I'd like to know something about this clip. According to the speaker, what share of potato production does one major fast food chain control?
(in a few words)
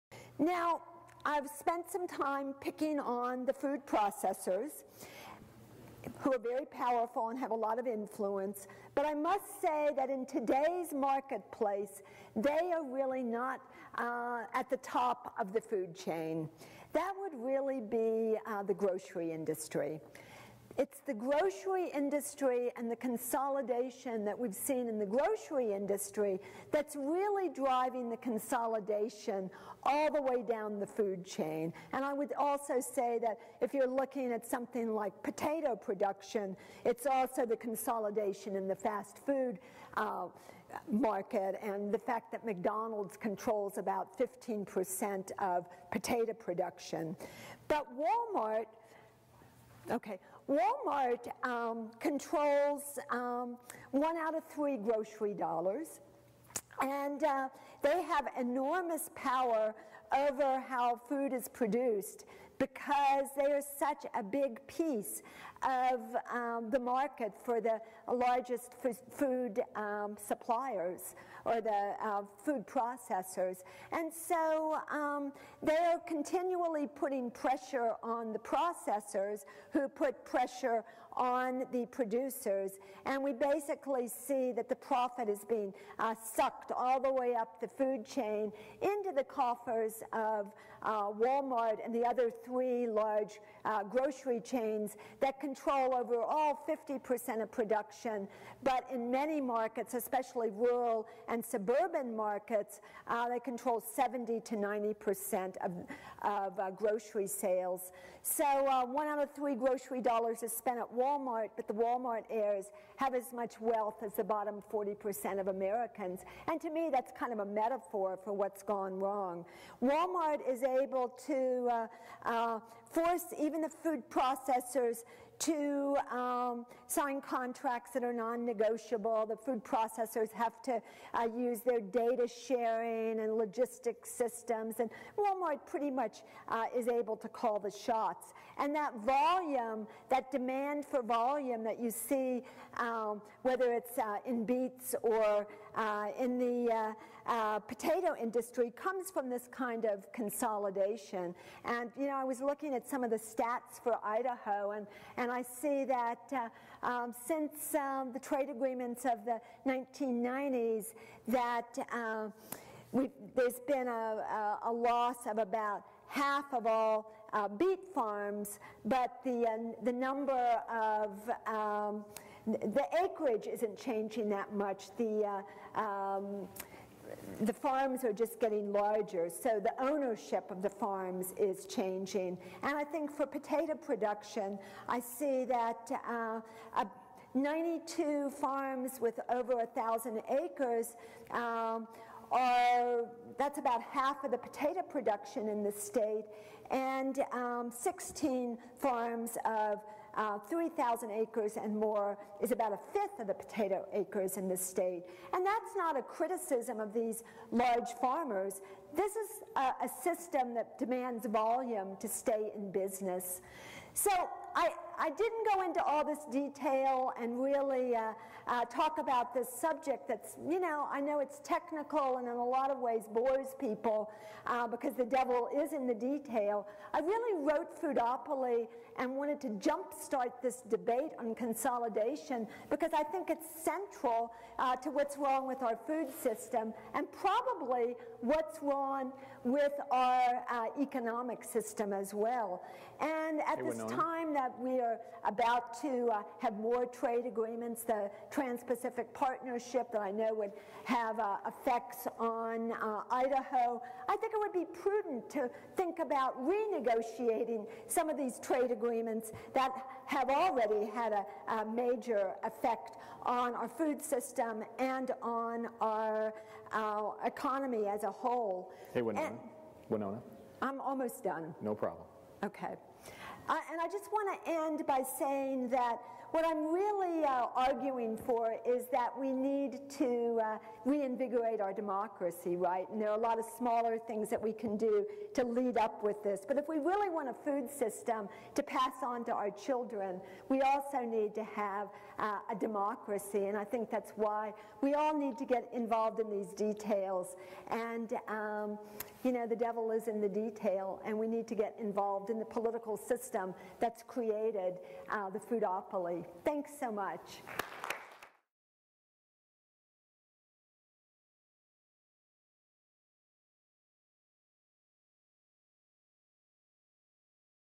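15%.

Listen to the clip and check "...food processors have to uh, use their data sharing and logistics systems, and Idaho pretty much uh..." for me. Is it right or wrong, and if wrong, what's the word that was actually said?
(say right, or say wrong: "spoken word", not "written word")
wrong: "Walmart", not "Idaho".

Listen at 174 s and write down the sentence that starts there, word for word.
The uh, um, the farms are just getting larger, so the ownership of the farms is changing.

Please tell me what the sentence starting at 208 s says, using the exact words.
This is a, a system that demands volume to stay in business.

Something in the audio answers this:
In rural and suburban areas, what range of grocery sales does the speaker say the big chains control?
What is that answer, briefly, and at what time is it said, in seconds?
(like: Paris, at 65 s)
70 to 90%, at 103 s.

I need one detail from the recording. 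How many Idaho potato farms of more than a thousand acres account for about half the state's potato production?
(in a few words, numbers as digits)
92.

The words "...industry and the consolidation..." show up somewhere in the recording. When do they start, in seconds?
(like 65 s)
21 s.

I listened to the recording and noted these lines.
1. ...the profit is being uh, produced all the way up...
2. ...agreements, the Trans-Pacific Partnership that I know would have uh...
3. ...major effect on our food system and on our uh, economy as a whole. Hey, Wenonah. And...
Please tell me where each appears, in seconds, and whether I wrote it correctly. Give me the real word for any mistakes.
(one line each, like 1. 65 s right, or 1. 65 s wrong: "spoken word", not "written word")
1. 84 s wrong: "sucked", not "produced"
2. 247 s right
3. 261 s right.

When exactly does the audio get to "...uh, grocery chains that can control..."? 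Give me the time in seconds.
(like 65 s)
93 s.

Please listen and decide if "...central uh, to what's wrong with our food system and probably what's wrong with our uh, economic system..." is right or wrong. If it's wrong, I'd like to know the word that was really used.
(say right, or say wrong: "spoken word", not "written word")
right.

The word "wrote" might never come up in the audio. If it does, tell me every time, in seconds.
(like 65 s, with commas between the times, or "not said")
227 s.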